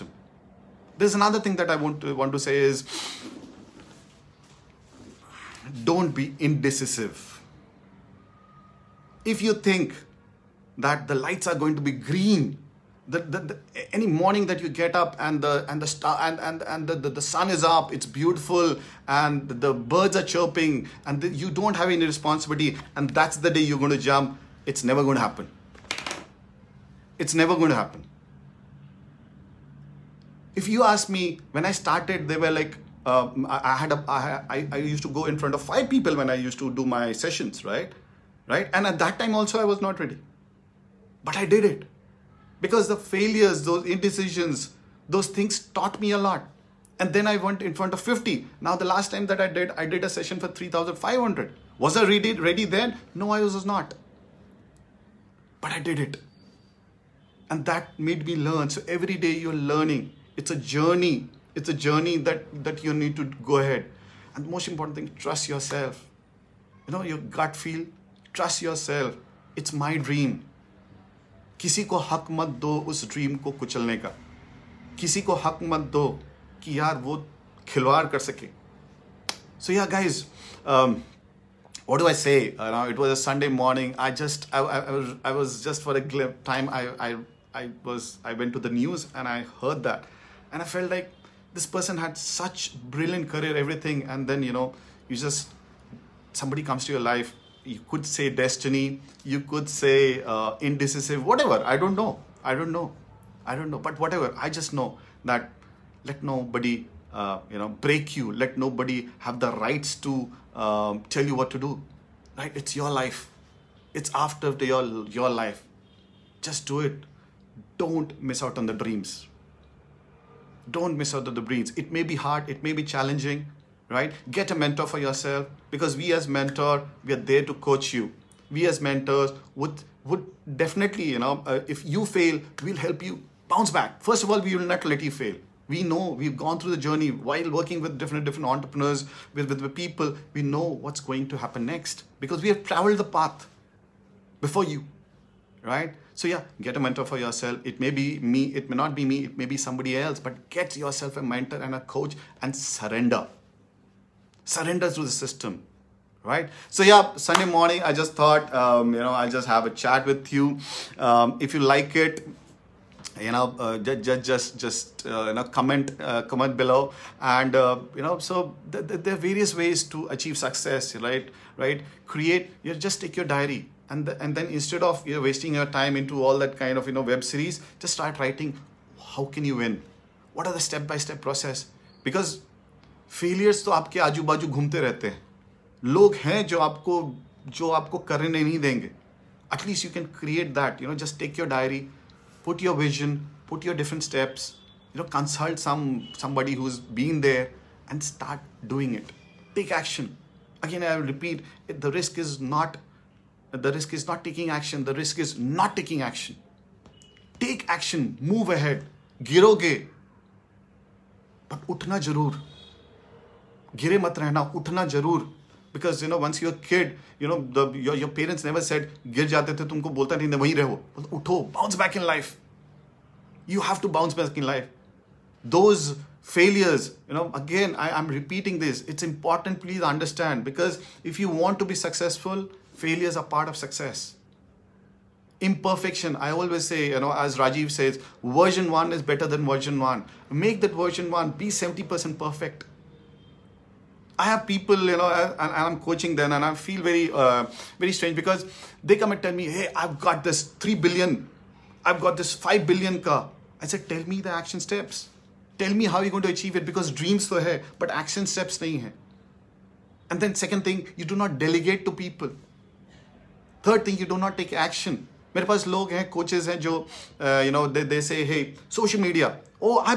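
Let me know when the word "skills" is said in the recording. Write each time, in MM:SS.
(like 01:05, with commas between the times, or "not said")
not said.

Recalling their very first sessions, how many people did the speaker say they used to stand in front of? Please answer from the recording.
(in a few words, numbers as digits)
5.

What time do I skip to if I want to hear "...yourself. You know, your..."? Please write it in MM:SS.
01:05.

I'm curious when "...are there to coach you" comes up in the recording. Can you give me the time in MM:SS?
02:07.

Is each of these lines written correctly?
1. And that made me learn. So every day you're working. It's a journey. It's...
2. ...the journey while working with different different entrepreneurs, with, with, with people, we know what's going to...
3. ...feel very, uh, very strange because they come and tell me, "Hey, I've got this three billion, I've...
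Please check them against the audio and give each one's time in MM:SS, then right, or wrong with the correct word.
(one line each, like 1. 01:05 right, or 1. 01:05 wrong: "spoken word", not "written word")
1. 00:57 wrong: "learning", not "working"
2. 02:16 right
3. 04:06 right.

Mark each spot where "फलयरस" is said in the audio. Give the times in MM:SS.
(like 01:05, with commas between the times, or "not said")
03:03, 03:46, 03:52.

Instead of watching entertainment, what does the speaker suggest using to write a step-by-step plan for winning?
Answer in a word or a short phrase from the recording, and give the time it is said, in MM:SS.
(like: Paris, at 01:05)
diary, at 02:53.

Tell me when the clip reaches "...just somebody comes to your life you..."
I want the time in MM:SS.
01:35.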